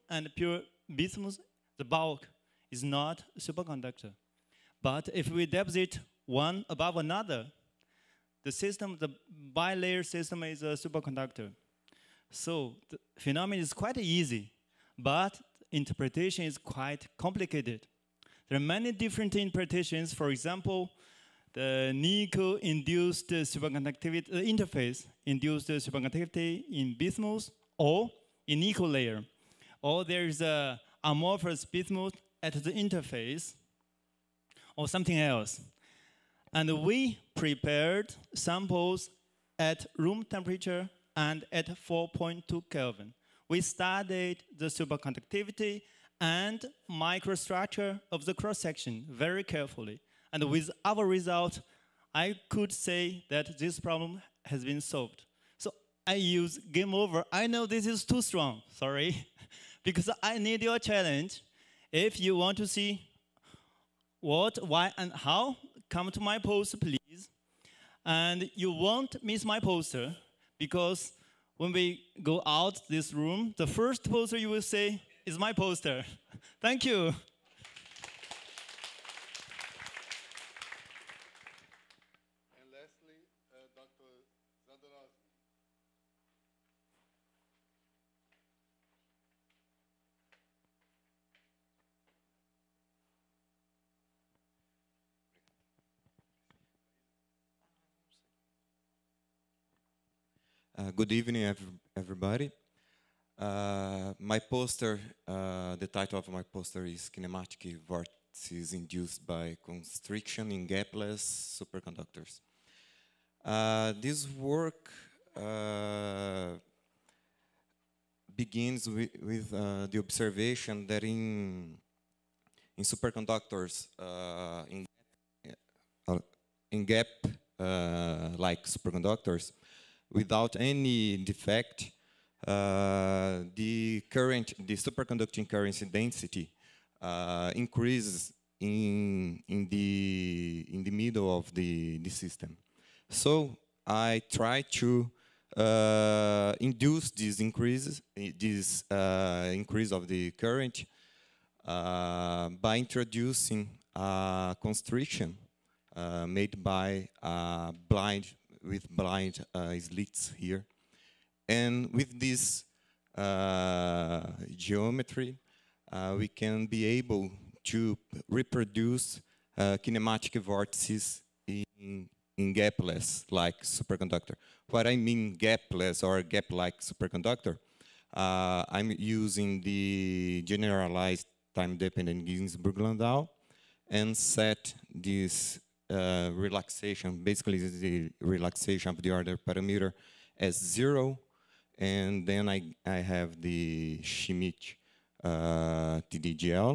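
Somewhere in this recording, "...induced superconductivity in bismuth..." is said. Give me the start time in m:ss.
0:25.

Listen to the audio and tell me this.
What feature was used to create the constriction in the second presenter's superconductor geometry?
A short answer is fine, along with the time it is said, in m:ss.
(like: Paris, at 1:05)
blind slits, at 2:38.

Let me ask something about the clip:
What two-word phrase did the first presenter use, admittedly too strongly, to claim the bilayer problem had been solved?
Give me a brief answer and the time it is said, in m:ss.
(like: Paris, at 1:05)
game over, at 0:56.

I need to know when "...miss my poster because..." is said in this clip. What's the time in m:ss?
1:09.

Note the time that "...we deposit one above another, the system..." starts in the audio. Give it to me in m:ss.
0:05.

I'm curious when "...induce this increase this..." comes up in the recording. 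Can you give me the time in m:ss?
2:26.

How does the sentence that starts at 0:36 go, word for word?
And we prepared samples at room temperature and at 4.2 Kelvin we studied the superconductivity and microstructure of the cross-section very carefully.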